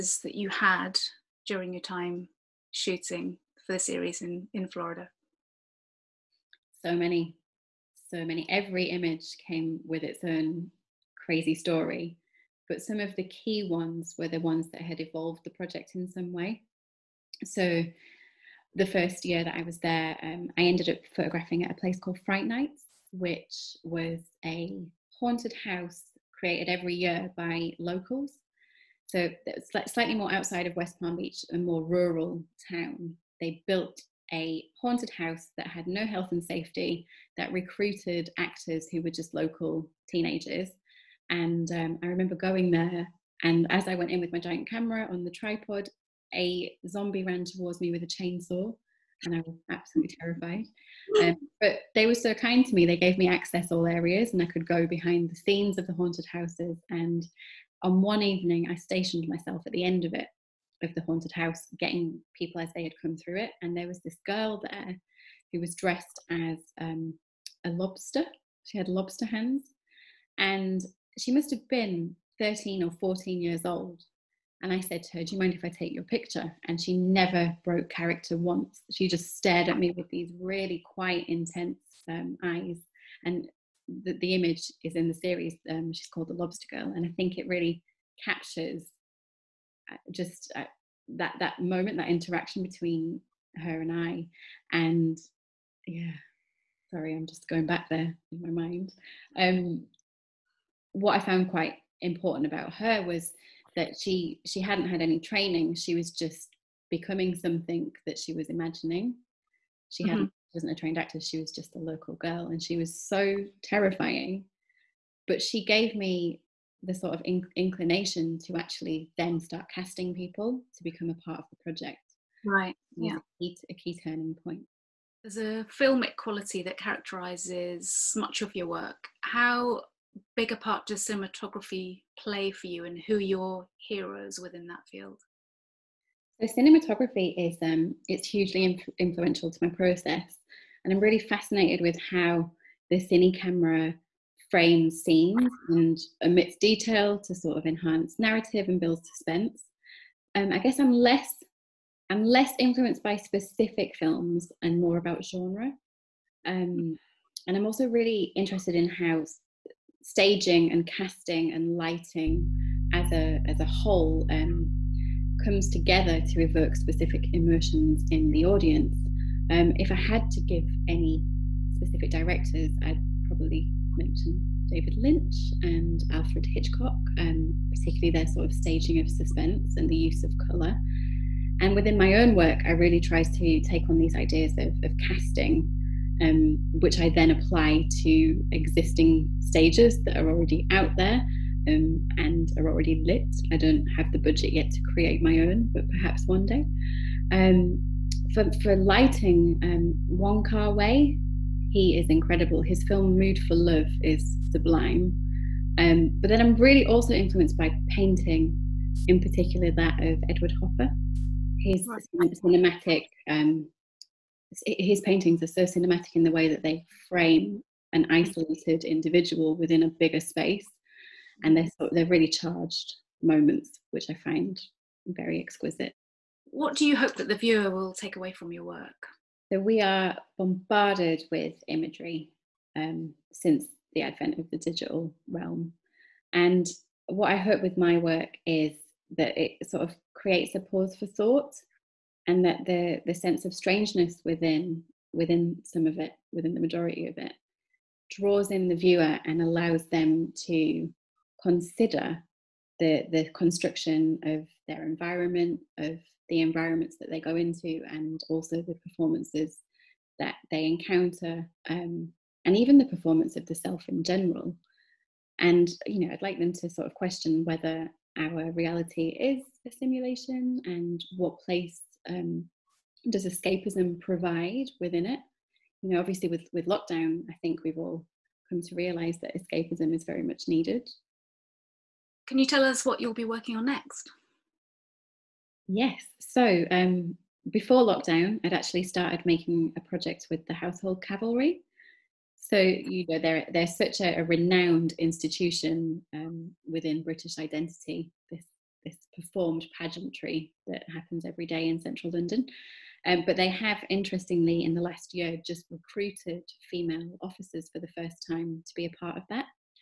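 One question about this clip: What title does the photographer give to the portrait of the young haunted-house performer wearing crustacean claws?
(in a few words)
the Lobster Girl.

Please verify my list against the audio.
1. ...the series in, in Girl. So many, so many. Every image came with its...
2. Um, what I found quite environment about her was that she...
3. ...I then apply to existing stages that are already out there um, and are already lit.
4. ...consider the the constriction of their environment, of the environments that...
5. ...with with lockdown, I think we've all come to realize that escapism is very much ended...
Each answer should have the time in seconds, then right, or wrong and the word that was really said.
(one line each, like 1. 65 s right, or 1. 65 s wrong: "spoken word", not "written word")
1. 3 s wrong: "Florida", not "Girl"
2. 99 s wrong: "important", not "environment"
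3. 187 s right
4. 251 s right
5. 276 s wrong: "needed", not "ended".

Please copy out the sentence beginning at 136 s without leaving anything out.
So cinematography is um, it's hugely inf- influential to my process.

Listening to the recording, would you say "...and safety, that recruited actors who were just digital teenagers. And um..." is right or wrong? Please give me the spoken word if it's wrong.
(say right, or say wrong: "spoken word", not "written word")
wrong: "local", not "digital".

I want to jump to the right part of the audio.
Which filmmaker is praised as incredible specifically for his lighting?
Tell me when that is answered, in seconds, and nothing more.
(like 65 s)
200 s.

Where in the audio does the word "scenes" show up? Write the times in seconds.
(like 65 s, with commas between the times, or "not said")
55 s, 145 s.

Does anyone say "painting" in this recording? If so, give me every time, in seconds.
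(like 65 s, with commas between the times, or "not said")
207 s, 215 s.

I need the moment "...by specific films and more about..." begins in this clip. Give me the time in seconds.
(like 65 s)
153 s.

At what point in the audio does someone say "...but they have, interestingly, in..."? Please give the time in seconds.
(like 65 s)
303 s.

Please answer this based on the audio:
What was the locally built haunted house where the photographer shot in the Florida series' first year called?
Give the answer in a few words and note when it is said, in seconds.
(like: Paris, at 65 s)
Fright Nights, at 22 s.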